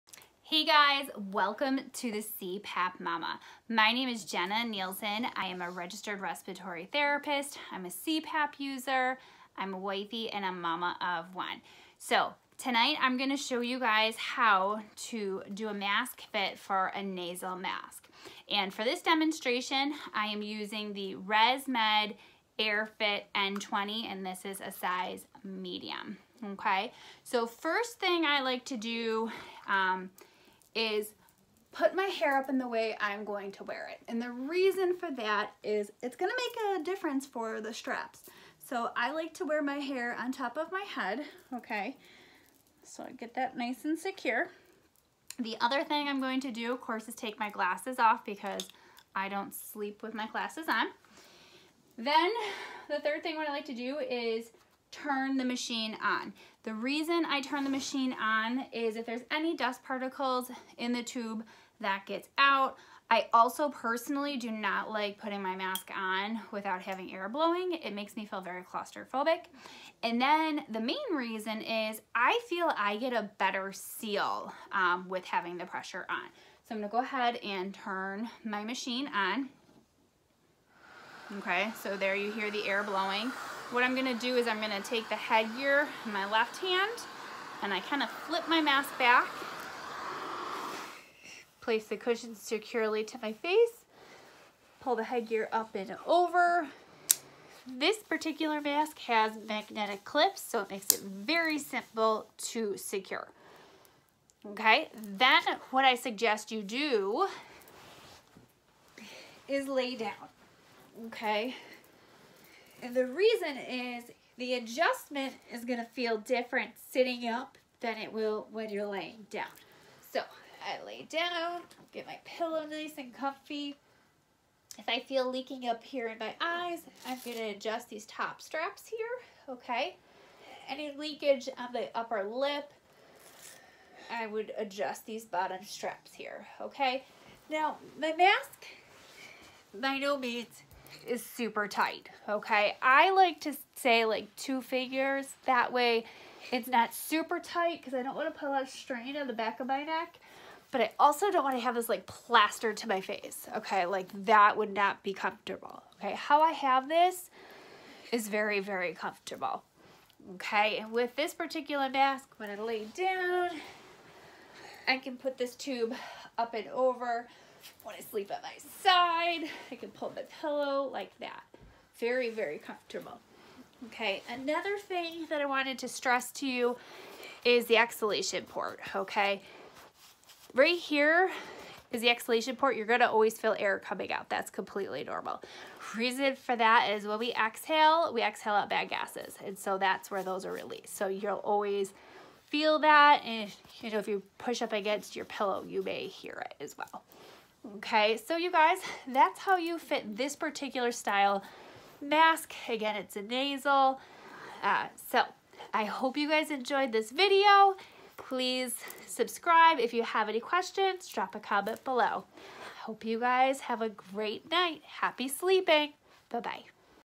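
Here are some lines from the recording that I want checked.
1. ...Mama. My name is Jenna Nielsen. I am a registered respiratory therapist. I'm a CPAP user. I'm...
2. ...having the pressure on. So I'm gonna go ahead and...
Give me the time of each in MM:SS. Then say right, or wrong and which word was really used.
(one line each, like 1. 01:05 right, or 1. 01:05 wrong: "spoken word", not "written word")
1. 00:02 right
2. 01:15 right.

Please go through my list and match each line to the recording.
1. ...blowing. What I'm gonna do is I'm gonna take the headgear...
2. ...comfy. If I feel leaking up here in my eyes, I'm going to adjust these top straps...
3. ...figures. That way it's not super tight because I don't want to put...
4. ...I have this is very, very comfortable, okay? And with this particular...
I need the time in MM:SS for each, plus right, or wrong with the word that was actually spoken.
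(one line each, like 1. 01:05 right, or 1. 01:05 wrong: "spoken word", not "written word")
1. 01:22 right
2. 02:03 right
3. 02:24 right
4. 02:36 right.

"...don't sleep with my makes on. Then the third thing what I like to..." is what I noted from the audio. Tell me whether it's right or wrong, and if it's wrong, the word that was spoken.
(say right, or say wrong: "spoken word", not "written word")
wrong: "glasses", not "makes".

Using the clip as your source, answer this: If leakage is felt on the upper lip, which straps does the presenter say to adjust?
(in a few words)
Bottom straps.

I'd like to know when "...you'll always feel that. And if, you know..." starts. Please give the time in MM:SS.
03:11.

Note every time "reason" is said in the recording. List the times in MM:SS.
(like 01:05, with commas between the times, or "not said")
00:34, 00:56, 01:11, 01:53, 03:05.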